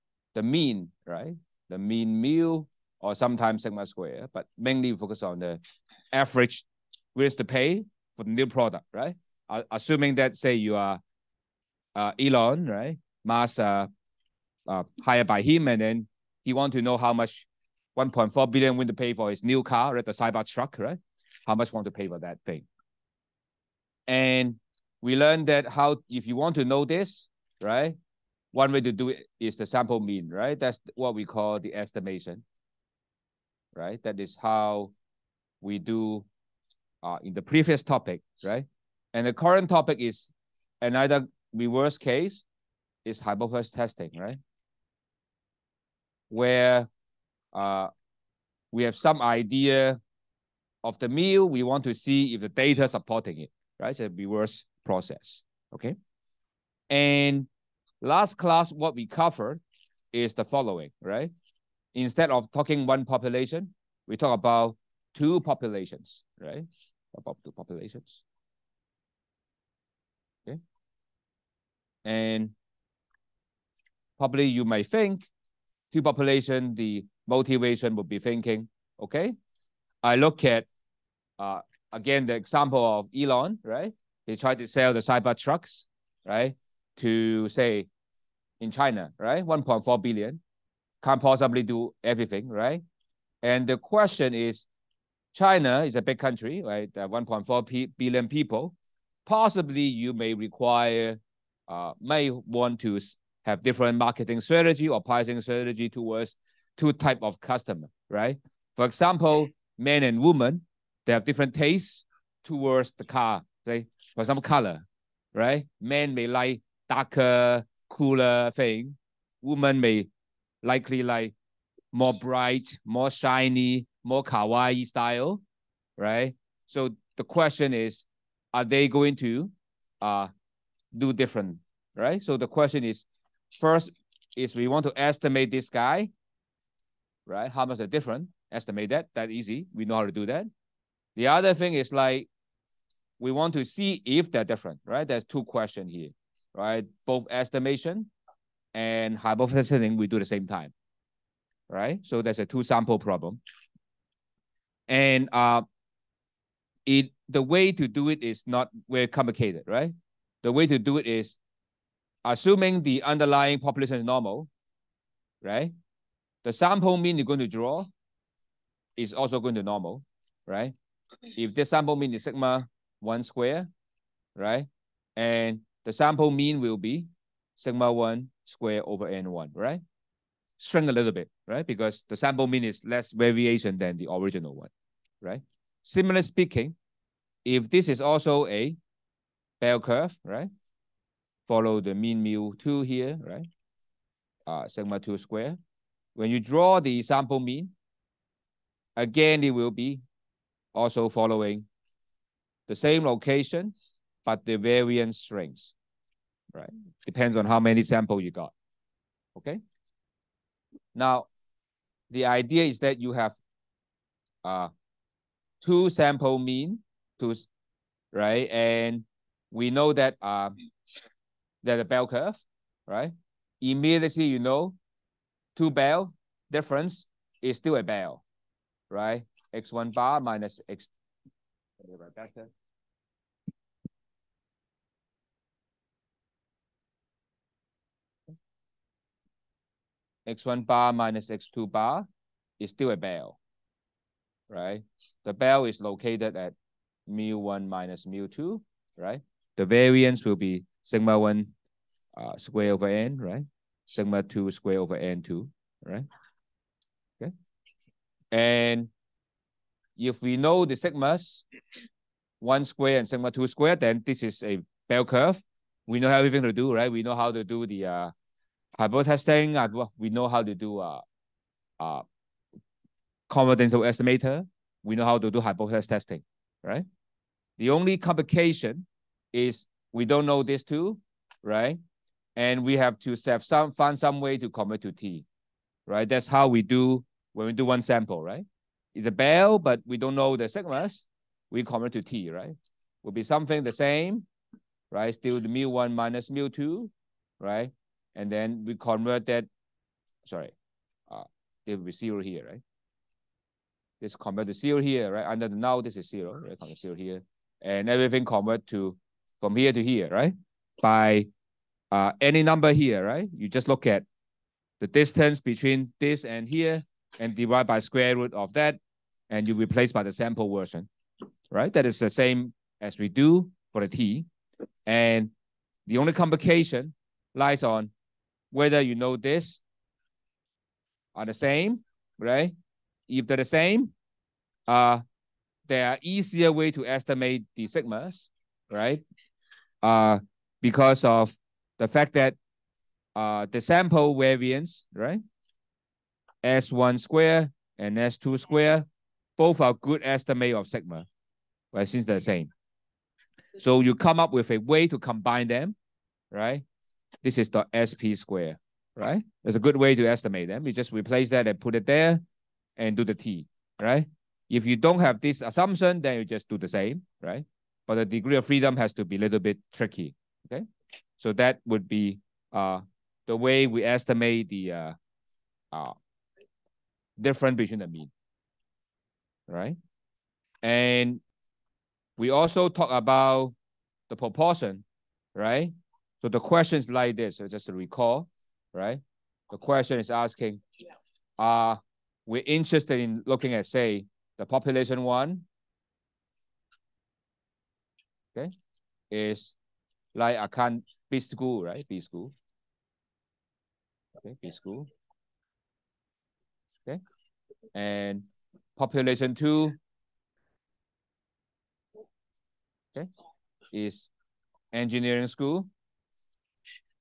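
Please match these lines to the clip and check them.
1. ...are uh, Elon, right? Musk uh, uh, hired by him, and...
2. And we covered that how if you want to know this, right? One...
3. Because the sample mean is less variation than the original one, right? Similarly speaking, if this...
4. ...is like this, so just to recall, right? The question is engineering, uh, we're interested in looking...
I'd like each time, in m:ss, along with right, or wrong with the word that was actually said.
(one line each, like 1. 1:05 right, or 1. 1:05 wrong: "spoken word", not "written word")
1. 0:10 right
2. 0:24 wrong: "learned", not "covered"
3. 3:01 right
4. 6:26 wrong: "asking", not "engineering".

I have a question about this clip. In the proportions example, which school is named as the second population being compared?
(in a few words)
engineering school.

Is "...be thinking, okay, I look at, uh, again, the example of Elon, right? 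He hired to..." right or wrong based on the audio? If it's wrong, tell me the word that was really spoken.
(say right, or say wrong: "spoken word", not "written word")
wrong: "tried", not "hired".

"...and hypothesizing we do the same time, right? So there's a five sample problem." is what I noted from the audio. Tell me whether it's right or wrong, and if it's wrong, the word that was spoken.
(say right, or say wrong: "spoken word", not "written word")
wrong: "two", not "five".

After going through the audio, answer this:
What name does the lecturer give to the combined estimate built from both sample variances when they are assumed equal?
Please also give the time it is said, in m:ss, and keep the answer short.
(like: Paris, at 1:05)
SP square, at 5:57.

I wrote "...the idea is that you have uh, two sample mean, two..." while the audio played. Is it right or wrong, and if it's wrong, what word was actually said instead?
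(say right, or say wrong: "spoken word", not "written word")
right.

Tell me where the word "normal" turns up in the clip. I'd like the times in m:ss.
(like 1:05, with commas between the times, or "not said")
2:44, 2:49.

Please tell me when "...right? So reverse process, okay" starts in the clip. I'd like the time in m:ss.
0:53.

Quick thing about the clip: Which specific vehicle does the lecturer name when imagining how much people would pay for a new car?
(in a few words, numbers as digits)
Cybertruck.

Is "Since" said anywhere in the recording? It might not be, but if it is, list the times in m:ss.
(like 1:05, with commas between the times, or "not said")
5:51.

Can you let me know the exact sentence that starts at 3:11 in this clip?
Follow the mean mu 2 here, right?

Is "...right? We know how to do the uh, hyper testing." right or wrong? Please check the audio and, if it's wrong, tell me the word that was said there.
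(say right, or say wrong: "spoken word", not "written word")
right.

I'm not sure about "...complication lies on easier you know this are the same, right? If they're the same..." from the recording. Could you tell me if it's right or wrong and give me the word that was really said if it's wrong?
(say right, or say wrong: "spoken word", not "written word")
wrong: "whether", not "easier".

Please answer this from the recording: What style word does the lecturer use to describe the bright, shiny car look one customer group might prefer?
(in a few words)
kawaii.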